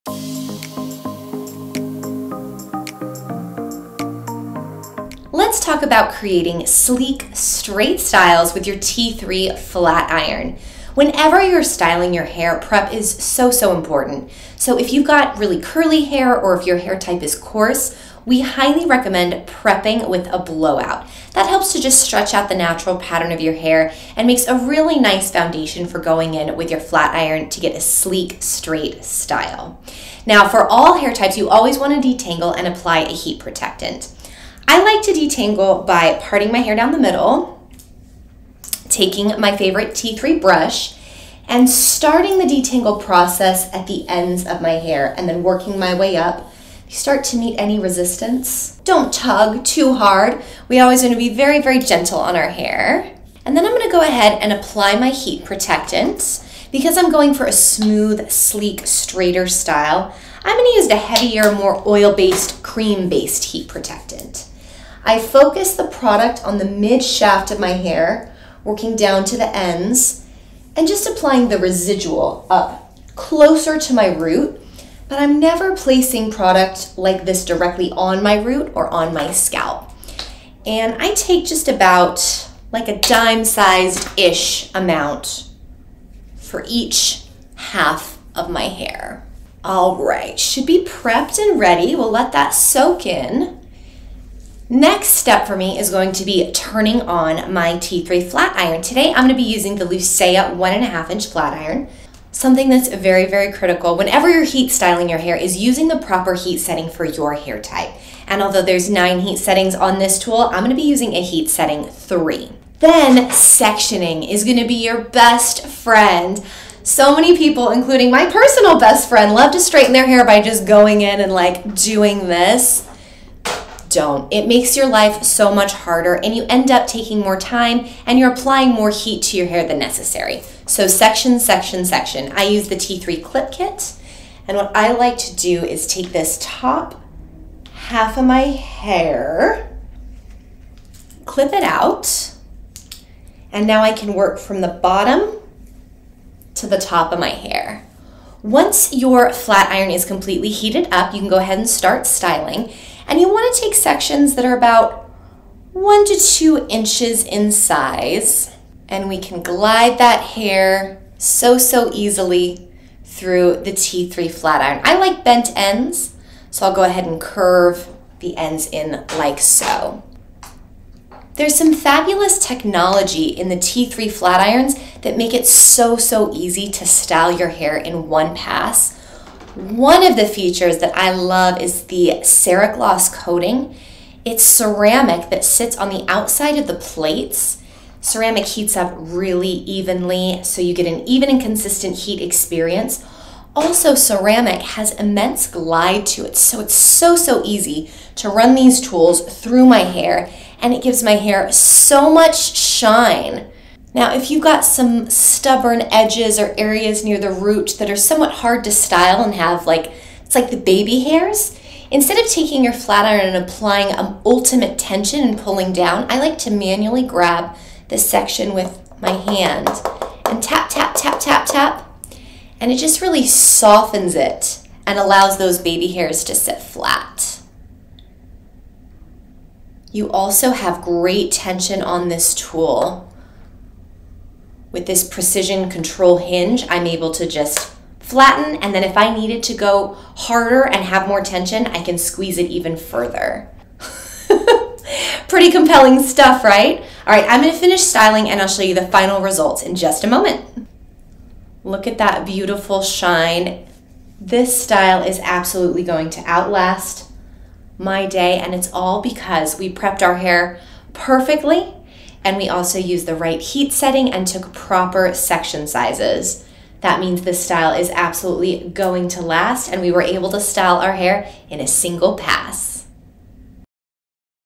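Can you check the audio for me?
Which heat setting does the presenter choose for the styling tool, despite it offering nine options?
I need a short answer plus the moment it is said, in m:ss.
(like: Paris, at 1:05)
3, at 1:51.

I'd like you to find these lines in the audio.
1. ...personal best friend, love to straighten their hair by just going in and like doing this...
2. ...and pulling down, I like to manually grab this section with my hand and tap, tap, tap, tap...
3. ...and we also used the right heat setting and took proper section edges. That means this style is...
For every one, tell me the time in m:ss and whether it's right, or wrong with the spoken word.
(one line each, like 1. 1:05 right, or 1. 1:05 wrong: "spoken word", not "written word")
1. 1:58 right
2. 3:35 right
3. 4:22 wrong: "sizes", not "edges".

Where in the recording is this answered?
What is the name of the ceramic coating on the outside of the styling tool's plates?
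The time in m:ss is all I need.
3:02.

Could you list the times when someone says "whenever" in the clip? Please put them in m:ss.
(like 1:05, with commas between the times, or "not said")
0:10, 1:43.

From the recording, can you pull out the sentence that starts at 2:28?
Once your flat iron is completely heated up, you can go ahead and start styling.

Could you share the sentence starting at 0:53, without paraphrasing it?
And then I'm going to go ahead and apply my heat protectant.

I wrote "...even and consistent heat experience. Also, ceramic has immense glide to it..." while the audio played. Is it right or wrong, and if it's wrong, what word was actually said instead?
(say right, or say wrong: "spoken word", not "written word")
right.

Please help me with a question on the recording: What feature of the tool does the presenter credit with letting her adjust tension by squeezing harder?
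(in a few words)
precision control hinge.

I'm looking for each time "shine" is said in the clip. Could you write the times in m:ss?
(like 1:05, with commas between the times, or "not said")
3:22, 4:12.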